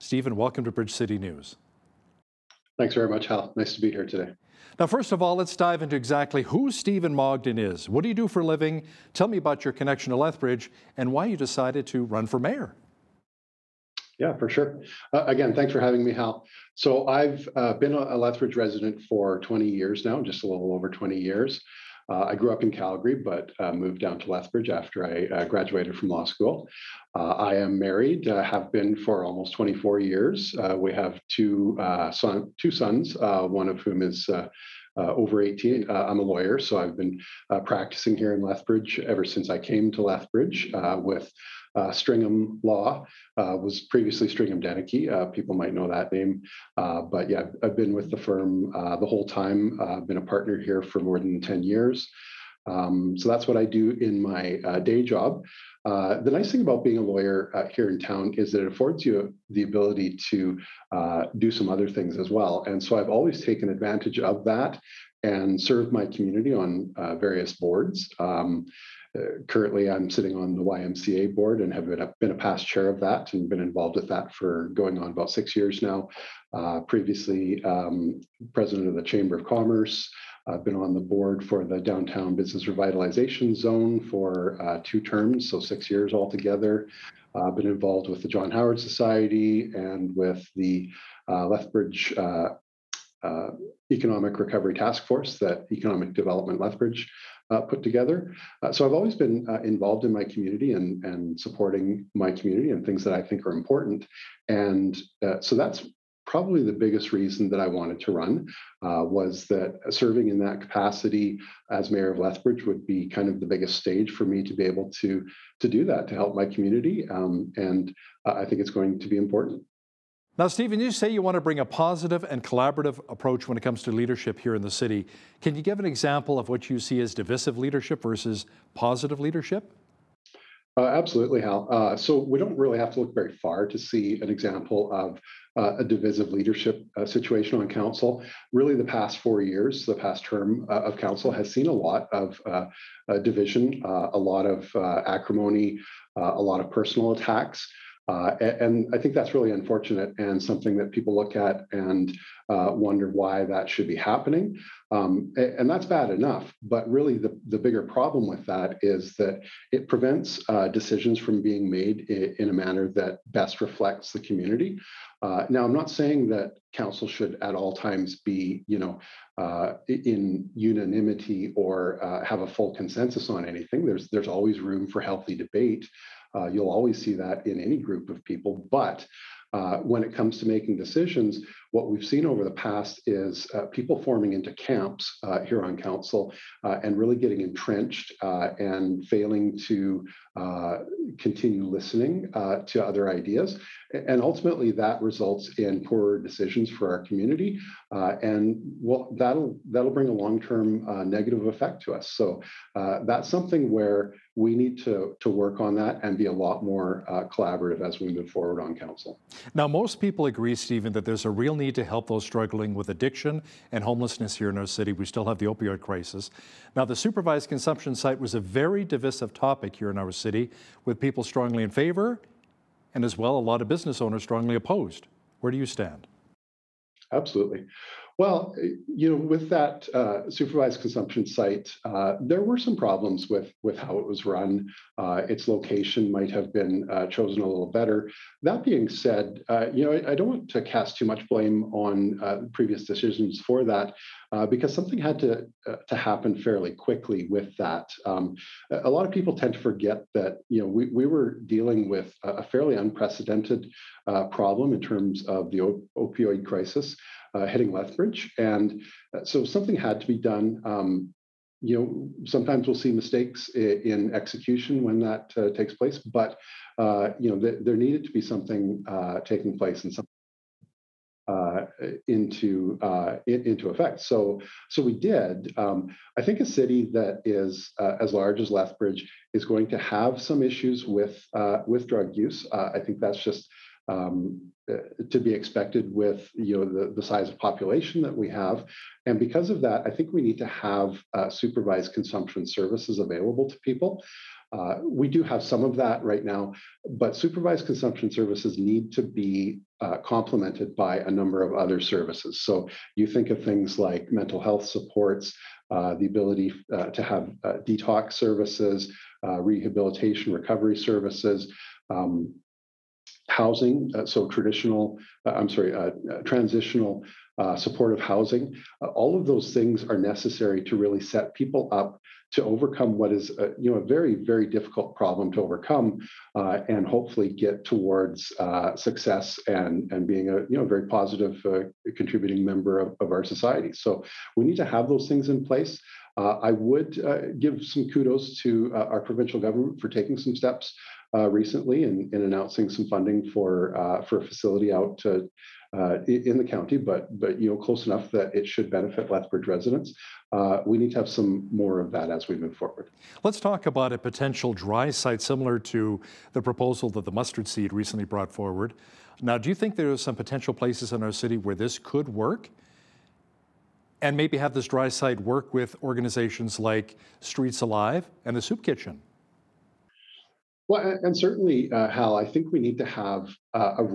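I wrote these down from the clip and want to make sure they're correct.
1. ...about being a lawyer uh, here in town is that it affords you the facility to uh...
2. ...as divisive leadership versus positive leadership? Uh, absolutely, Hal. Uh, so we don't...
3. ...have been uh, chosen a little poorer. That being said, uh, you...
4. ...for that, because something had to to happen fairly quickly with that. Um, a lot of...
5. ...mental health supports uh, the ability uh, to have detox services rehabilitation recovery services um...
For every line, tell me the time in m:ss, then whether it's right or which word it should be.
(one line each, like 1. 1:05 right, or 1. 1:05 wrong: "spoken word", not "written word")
1. 0:56 wrong: "ability", not "facility"
2. 2:07 right
3. 3:56 wrong: "better", not "poorer"
4. 4:03 right
5. 5:04 right.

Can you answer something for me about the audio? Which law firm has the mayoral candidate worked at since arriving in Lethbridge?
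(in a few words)
Stringam Law.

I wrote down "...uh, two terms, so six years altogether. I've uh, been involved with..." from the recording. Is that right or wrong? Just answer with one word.
right.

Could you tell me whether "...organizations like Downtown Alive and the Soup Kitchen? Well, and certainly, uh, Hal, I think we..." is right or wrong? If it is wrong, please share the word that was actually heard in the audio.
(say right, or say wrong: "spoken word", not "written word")
wrong: "Streets", not "Downtown".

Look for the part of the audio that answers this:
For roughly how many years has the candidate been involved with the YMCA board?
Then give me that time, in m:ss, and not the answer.
1:15.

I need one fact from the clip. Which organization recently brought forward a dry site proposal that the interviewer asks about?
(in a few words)
Mustard Seed.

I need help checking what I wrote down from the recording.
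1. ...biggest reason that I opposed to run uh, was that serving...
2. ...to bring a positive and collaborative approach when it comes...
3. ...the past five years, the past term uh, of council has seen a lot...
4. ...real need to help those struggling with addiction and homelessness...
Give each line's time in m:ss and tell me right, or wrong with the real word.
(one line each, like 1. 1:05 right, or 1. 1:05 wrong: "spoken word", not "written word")
1. 1:46 wrong: "wanted", not "opposed"
2. 2:01 right
3. 2:18 wrong: "four", not "five"
4. 3:31 right.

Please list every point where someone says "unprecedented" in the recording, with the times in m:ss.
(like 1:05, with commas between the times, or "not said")
4:12.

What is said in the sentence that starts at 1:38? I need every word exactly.
Uh, so I've always been uh, involved in my community and, and supporting my community and things that I think are important.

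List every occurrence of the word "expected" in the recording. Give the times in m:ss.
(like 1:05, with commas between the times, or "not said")
4:45.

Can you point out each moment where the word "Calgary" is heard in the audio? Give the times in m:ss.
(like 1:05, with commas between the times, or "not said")
0:22.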